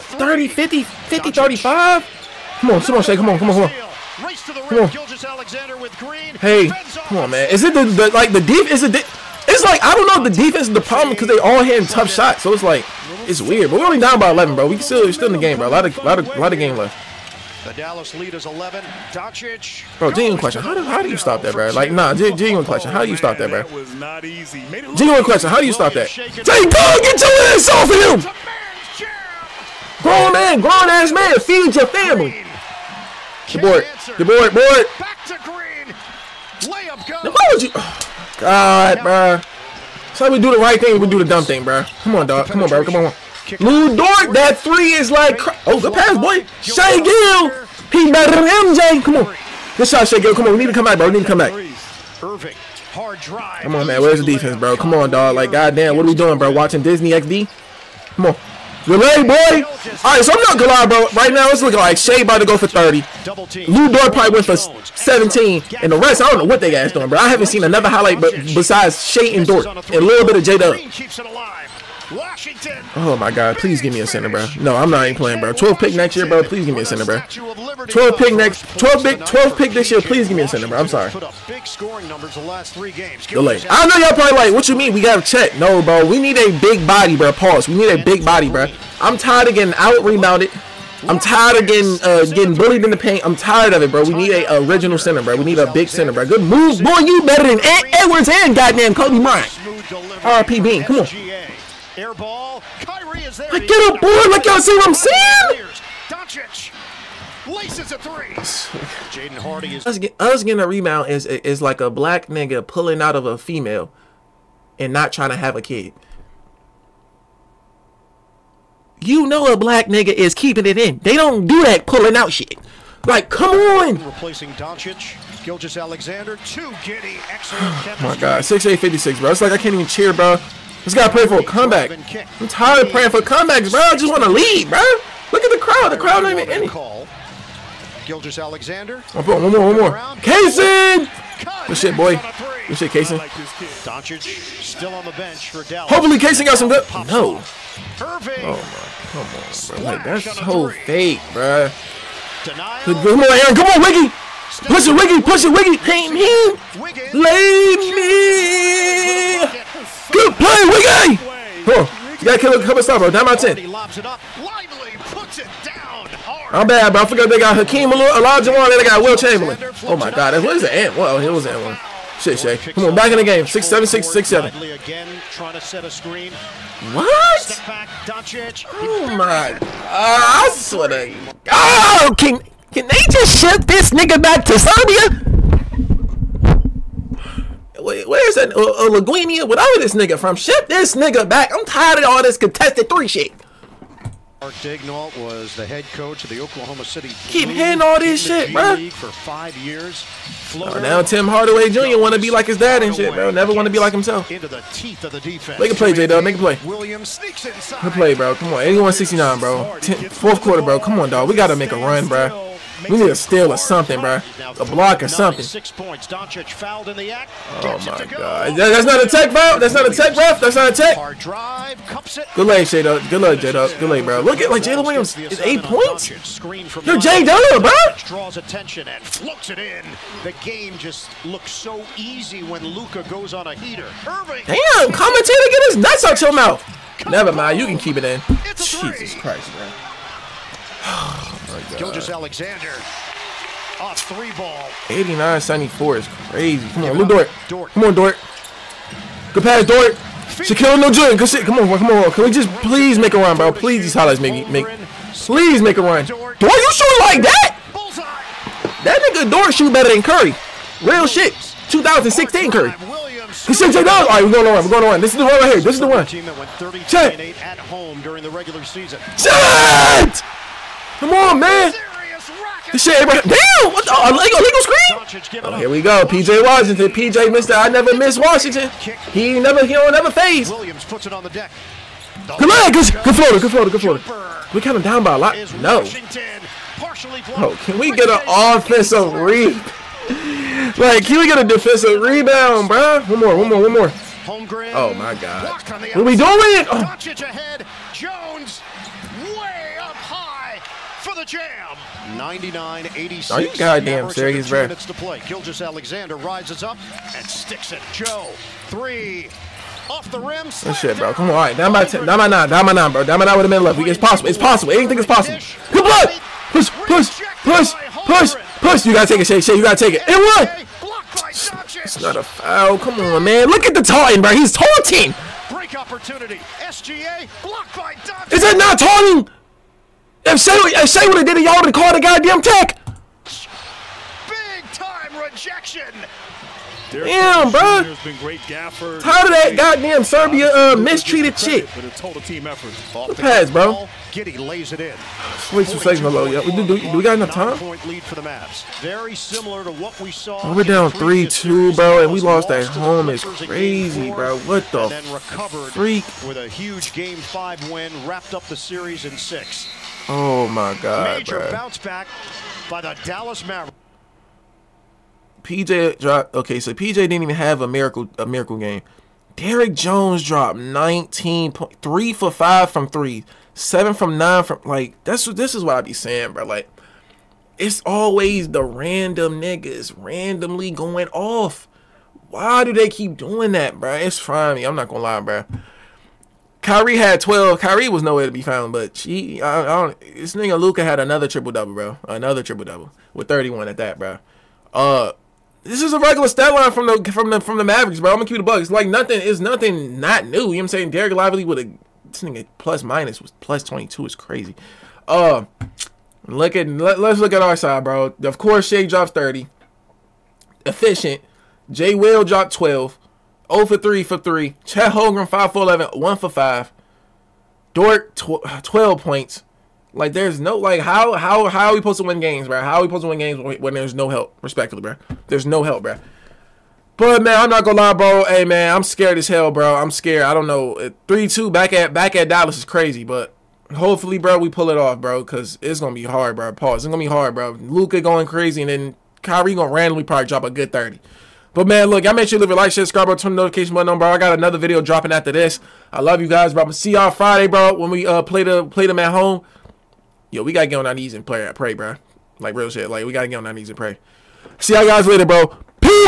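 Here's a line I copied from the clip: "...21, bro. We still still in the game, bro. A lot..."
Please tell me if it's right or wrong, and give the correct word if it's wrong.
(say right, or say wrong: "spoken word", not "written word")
wrong: "11", not "21".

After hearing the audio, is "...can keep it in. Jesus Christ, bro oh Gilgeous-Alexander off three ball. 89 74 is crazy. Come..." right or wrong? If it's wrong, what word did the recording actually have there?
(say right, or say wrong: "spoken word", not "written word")
right.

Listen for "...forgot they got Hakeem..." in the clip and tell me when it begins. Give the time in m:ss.
2:47.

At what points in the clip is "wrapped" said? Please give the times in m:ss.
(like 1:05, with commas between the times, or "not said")
5:58.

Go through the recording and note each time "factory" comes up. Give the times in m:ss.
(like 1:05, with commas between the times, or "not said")
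not said.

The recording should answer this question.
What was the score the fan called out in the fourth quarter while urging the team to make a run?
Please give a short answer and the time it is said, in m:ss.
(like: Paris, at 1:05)
81-69, at 3:28.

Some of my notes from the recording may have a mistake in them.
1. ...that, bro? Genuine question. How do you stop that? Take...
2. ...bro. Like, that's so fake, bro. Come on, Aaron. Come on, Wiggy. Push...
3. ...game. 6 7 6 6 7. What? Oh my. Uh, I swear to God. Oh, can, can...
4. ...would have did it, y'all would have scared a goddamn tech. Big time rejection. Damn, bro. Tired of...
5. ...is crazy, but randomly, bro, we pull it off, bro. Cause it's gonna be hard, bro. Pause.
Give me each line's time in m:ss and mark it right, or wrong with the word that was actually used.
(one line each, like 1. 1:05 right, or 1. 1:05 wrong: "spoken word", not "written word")
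1. 0:23 right
2. 2:29 right
3. 2:53 right
4. 5:31 wrong: "called", not "scared"
5. 7:12 wrong: "hopefully", not "randomly".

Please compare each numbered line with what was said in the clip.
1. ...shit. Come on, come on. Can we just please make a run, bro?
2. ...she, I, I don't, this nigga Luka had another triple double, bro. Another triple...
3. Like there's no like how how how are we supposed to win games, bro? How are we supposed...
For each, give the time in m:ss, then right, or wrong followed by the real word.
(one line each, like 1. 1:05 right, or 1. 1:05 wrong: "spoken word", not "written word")
1. 4:11 right
2. 6:28 right
3. 6:59 right.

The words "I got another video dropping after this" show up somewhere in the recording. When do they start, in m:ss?
7:24.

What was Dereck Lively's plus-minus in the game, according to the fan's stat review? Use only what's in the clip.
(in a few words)
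plus 22.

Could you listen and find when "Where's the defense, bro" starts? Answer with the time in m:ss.
0:54.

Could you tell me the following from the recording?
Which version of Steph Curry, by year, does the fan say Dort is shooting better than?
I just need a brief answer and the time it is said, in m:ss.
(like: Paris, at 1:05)
2016 Curry, at 4:21.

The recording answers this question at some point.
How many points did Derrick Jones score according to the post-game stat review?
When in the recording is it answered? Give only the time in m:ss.
6:10.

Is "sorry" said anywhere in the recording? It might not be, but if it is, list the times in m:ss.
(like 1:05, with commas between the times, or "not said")
1:20.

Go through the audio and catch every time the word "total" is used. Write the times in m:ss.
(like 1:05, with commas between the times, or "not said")
5:41.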